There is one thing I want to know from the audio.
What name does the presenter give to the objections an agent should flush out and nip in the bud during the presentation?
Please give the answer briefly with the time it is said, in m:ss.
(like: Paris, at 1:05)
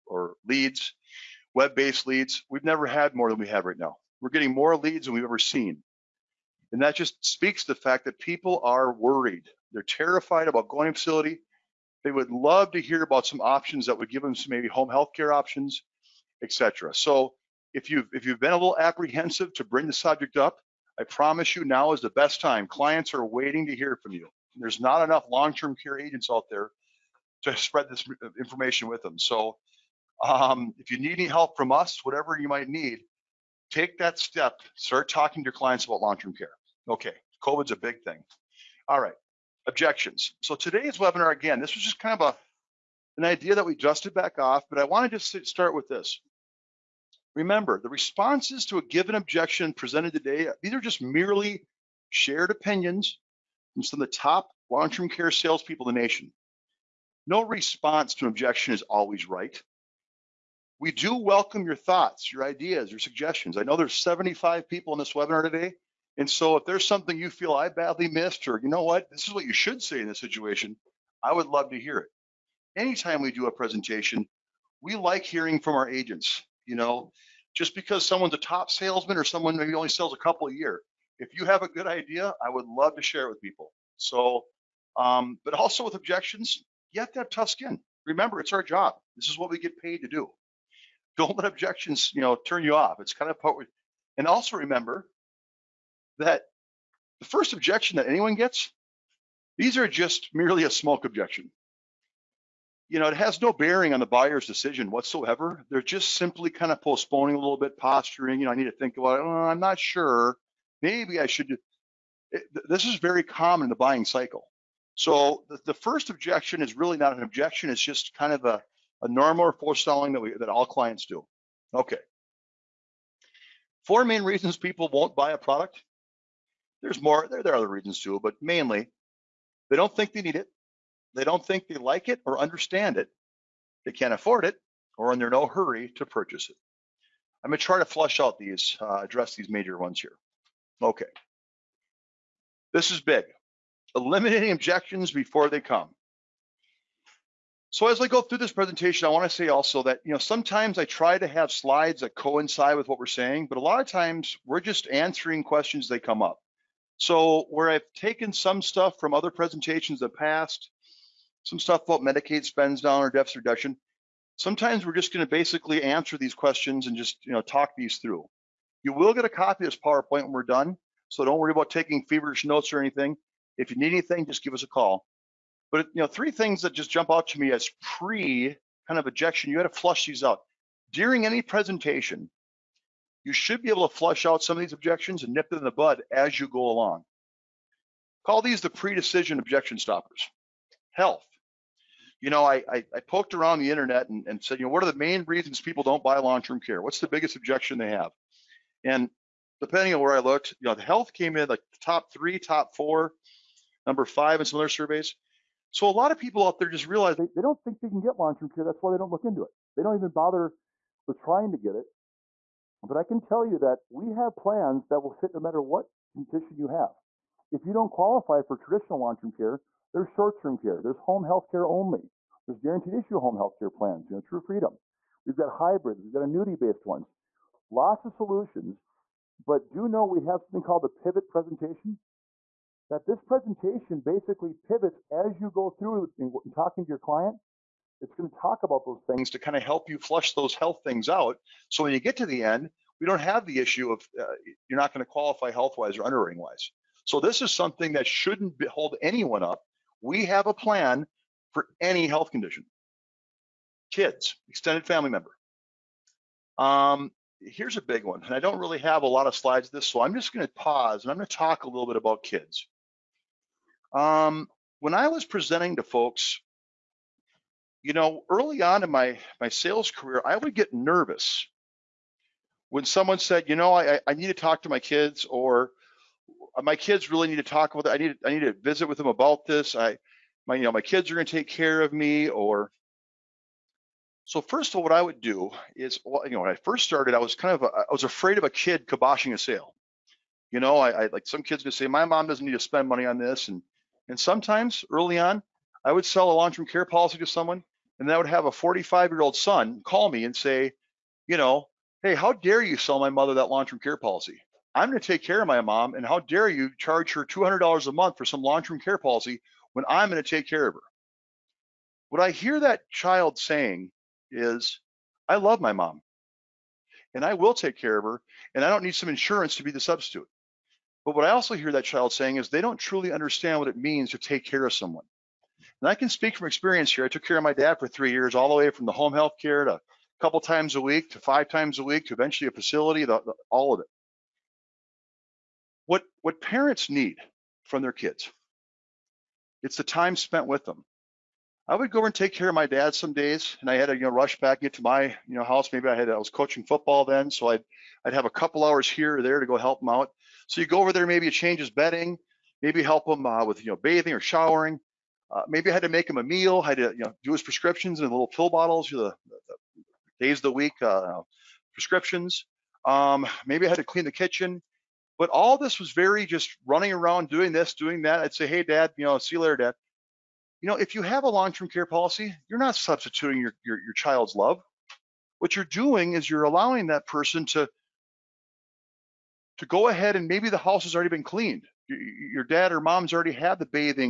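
pre-decision objection stoppers, at 3:08.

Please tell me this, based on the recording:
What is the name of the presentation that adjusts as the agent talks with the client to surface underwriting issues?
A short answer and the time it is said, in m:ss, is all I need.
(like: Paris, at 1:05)
pivot presentation, at 3:50.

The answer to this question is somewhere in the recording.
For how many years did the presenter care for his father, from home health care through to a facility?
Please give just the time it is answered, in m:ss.
5:27.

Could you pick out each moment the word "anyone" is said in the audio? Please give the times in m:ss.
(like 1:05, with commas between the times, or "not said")
1:38, 4:09.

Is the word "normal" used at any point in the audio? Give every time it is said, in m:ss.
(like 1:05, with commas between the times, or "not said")
1:59.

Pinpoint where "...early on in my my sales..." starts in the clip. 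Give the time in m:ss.
4:28.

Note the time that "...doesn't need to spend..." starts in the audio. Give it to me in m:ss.
4:52.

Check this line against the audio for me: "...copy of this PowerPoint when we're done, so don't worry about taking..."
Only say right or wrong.
right.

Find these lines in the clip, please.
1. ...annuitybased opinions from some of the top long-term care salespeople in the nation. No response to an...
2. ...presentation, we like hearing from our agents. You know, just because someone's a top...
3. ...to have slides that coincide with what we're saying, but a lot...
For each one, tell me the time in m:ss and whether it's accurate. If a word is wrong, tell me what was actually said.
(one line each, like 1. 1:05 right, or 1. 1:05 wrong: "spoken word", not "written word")
1. 0:52 wrong: "shared", not "annuitybased"
2. 1:13 right
3. 2:31 right.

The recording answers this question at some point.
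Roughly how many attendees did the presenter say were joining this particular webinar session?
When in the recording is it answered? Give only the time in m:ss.
1:03.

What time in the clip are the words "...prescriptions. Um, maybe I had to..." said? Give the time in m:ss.
6:01.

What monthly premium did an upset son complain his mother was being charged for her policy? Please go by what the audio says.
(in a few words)
$200.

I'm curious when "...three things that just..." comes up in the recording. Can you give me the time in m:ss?
2:56.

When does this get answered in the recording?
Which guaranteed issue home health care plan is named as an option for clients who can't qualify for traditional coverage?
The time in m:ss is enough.
3:44.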